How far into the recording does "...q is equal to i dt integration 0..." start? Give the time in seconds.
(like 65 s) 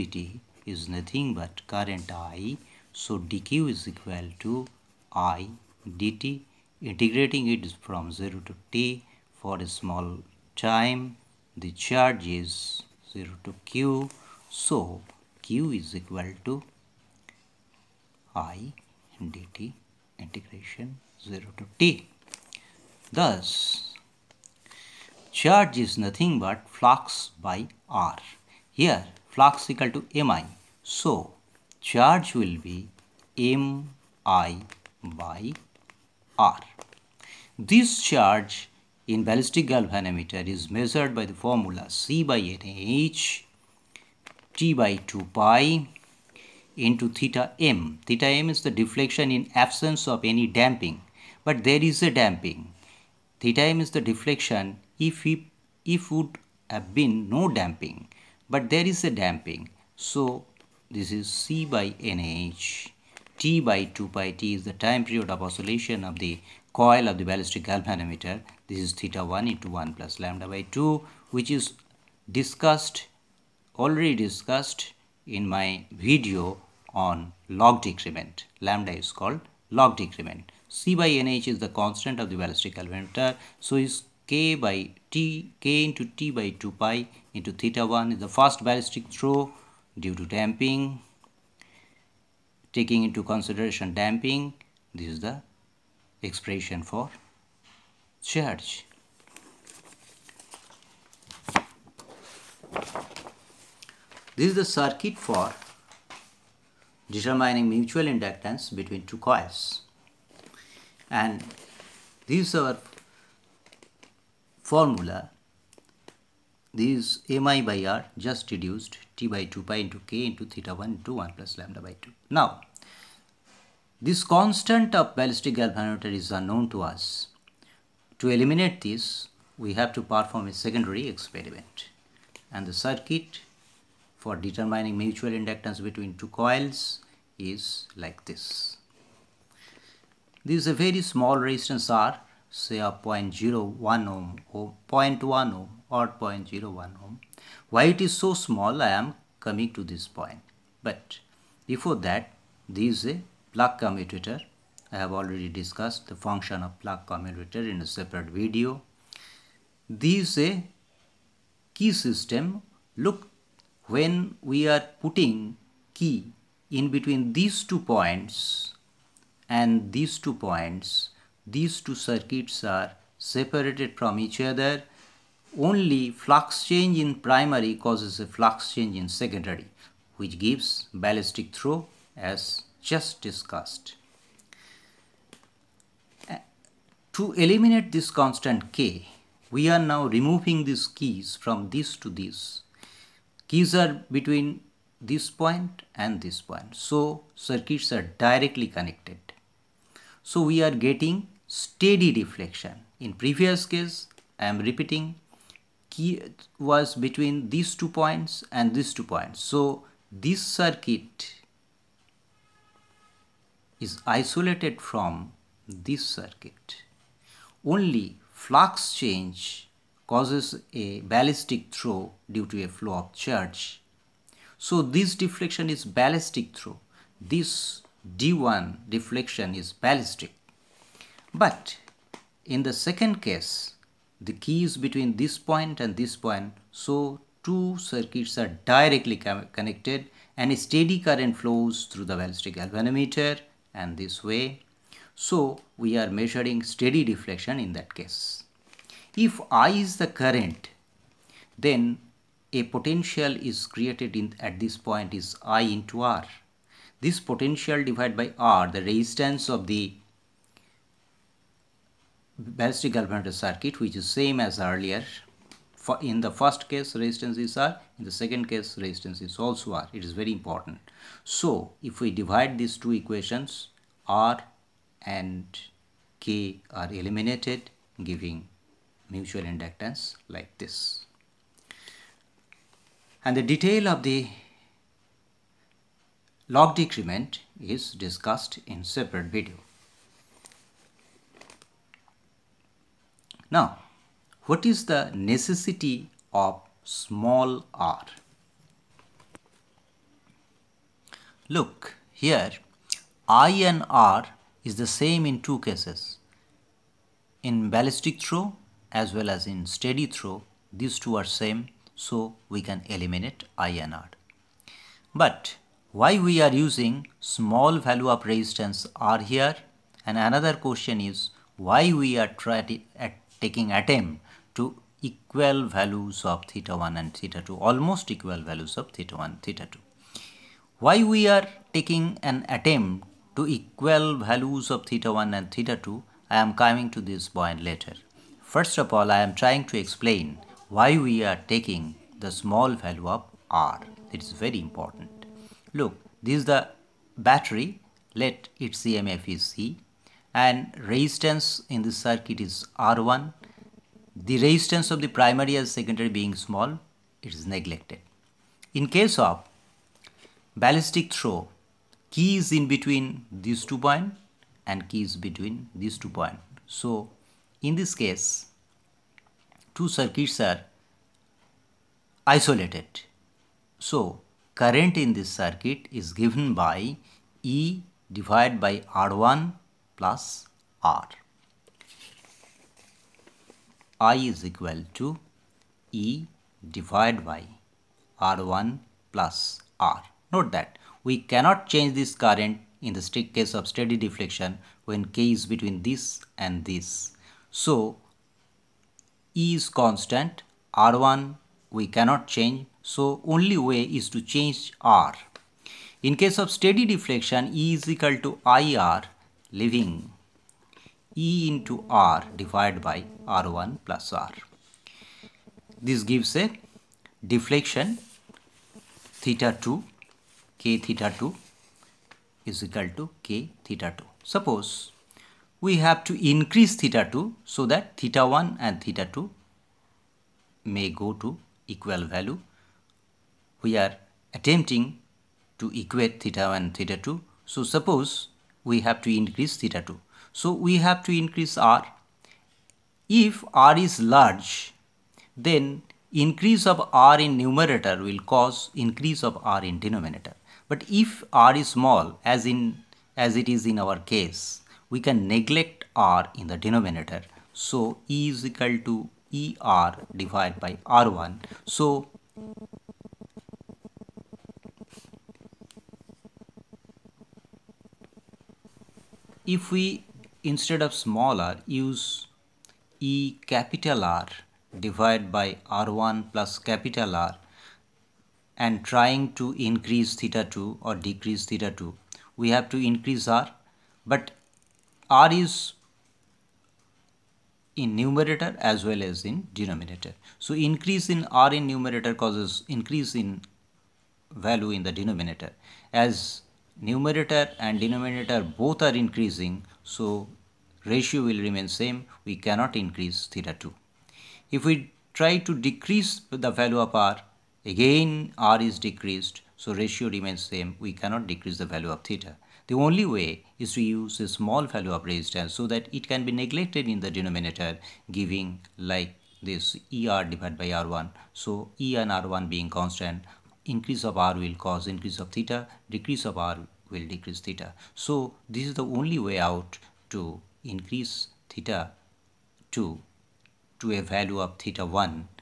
15 s.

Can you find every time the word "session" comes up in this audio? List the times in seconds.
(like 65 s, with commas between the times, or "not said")
not said.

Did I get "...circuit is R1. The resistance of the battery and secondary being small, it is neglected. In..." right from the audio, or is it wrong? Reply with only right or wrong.
wrong.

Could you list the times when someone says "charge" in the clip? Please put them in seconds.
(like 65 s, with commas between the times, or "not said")
11 s, 25 s, 31 s, 38 s, 98 s, 223 s.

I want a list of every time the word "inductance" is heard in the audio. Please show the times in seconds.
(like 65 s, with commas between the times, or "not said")
108 s, 135 s, 279 s.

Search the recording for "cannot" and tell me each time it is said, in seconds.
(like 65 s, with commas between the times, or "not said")
391 s, 401 s, 502 s, 510 s.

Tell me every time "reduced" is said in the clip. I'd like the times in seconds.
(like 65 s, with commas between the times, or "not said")
118 s.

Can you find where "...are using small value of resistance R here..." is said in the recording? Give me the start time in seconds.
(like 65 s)
316 s.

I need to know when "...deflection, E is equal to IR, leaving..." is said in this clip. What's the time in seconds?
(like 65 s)
406 s.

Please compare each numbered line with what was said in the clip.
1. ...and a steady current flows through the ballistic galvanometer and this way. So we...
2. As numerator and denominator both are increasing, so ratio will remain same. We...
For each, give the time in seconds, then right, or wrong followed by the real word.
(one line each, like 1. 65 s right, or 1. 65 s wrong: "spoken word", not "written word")
1. 240 s right
2. 495 s right.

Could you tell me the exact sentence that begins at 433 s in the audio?
We are attempting to equate theta 1 and theta 2.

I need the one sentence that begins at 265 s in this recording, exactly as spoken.
For in the first case resistance is R, in the second case resistance is also R.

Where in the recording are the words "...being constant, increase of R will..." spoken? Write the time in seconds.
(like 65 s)
522 s.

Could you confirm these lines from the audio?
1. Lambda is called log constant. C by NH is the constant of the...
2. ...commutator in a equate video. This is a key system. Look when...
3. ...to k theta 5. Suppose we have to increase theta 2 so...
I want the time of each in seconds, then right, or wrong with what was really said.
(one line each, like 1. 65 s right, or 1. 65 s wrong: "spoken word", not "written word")
1. 78 s wrong: "decrement", not "constant"
2. 157 s wrong: "separate", not "equate"
3. 422 s wrong: "2", not "5".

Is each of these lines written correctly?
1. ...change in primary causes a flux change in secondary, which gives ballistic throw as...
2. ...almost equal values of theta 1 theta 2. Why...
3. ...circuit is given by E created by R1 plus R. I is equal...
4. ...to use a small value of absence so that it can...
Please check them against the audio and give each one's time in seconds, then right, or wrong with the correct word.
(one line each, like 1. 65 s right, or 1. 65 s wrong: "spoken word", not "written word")
1. 176 s right
2. 327 s right
3. 375 s wrong: "divided", not "created"
4. 513 s wrong: "resistance", not "absence".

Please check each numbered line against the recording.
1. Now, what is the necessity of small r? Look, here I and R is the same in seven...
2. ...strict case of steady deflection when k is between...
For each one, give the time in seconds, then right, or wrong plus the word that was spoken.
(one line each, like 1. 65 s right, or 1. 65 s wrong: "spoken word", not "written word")
1. 293 s wrong: "two", not "seven"
2. 393 s right.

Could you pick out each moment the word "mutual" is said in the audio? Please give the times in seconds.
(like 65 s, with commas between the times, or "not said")
107 s, 134 s, 279 s.